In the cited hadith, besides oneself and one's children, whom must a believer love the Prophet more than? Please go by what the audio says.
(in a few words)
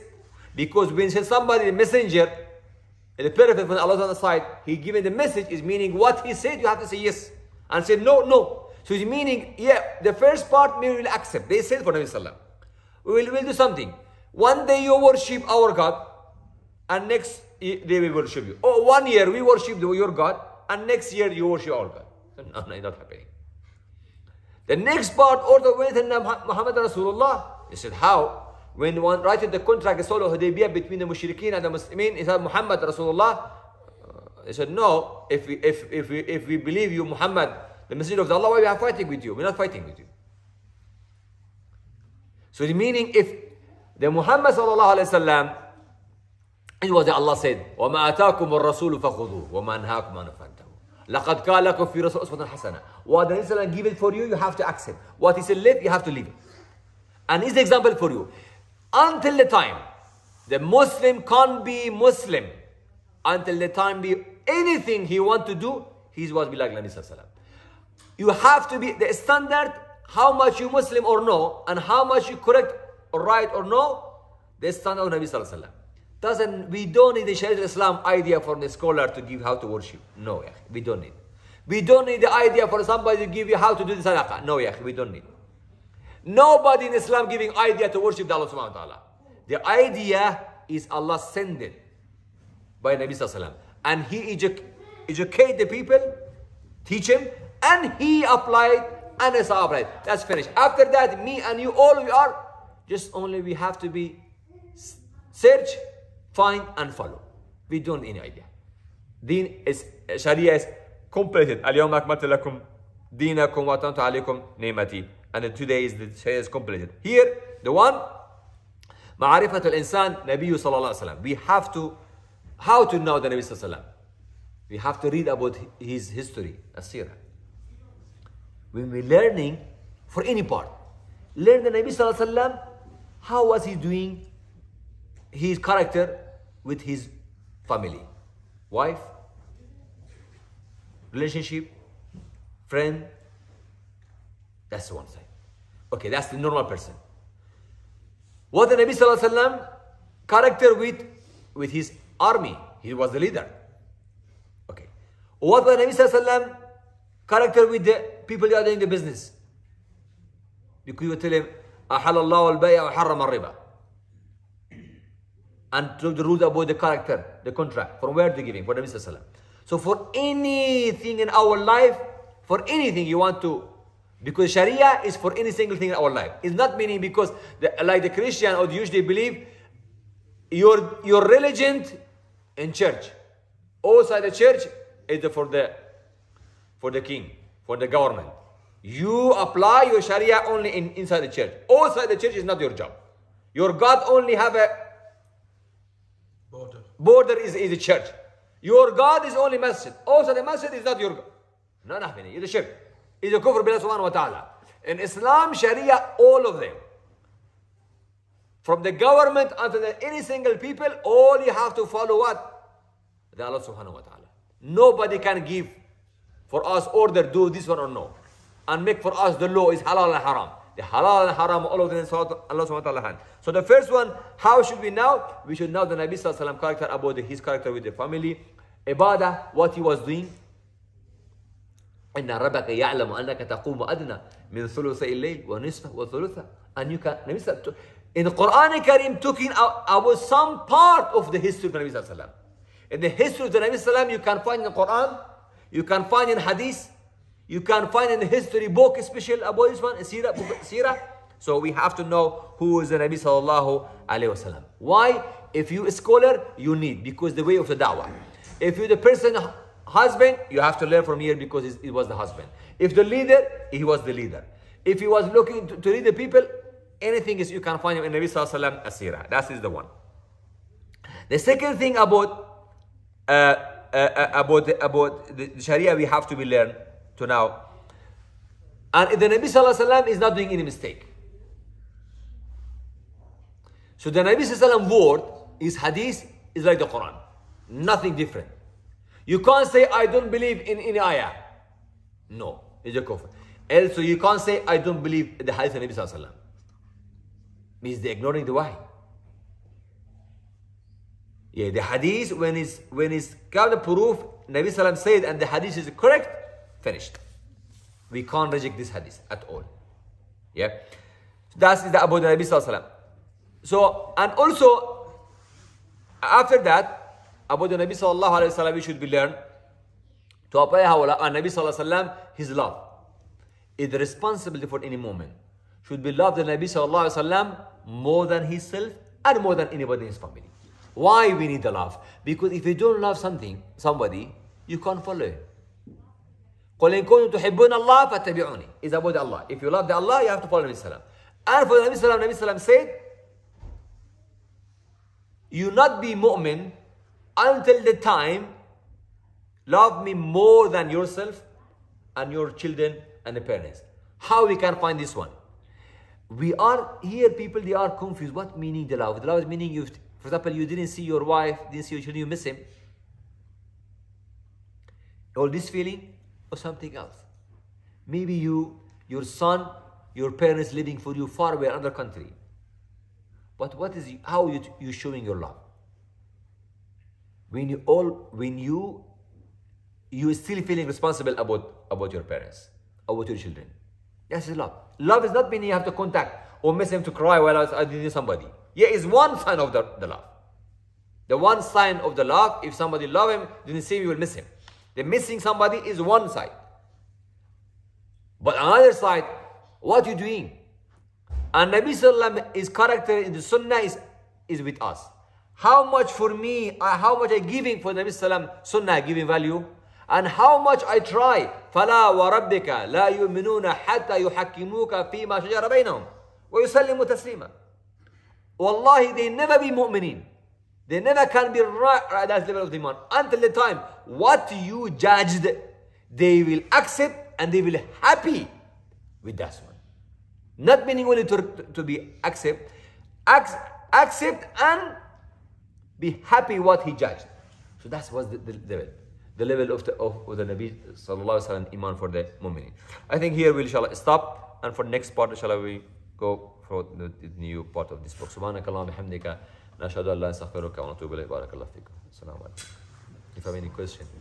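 the parents.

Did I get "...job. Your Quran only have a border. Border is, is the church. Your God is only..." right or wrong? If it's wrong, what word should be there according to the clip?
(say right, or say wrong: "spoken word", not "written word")
wrong: "God", not "Quran".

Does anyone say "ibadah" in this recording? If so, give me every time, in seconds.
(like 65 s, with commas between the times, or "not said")
228 s.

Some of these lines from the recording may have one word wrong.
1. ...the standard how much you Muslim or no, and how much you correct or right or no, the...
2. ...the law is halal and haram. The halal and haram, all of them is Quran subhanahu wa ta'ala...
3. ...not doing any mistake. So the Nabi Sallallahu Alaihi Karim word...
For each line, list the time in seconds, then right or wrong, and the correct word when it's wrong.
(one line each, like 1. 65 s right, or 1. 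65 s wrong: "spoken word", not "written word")
1. 68 s right
2. 219 s wrong: "Allah", not "Quran"
3. 280 s wrong: "Wasallam", not "Karim".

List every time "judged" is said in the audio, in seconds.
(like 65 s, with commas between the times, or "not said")
424 s, 436 s.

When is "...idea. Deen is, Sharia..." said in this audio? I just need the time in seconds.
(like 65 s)
108 s.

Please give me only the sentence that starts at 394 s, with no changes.
The missing somebody is one side.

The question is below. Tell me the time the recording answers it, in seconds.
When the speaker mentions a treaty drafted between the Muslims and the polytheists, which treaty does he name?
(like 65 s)
30 s.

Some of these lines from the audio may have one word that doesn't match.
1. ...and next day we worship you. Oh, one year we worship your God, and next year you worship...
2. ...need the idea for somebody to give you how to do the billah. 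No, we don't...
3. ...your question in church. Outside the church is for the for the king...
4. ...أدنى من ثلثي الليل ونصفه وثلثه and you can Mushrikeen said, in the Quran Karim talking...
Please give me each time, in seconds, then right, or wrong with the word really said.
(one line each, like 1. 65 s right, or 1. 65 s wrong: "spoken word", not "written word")
1. 16 s right
2. 82 s wrong: "sadaqah", not "billah"
3. 181 s wrong: "religion", not "question"
4. 233 s wrong: "Nabi", not "Mushrikeen".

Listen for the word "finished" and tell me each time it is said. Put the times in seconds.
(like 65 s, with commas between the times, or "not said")
100 s, 306 s.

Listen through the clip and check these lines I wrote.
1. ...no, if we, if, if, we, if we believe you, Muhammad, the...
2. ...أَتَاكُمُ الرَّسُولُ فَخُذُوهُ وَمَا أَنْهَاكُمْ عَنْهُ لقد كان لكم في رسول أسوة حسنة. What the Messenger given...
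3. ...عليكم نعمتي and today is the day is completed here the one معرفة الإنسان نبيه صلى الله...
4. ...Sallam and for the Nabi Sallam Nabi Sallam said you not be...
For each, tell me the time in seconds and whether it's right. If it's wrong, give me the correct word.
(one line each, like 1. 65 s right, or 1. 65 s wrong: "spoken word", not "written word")
1. 34 s right
2. 48 s right
3. 113 s right
4. 340 s right.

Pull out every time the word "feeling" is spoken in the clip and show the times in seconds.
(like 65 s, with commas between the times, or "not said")
365 s, 380 s.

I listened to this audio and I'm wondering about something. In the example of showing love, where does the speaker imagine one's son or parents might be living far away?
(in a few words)
another country.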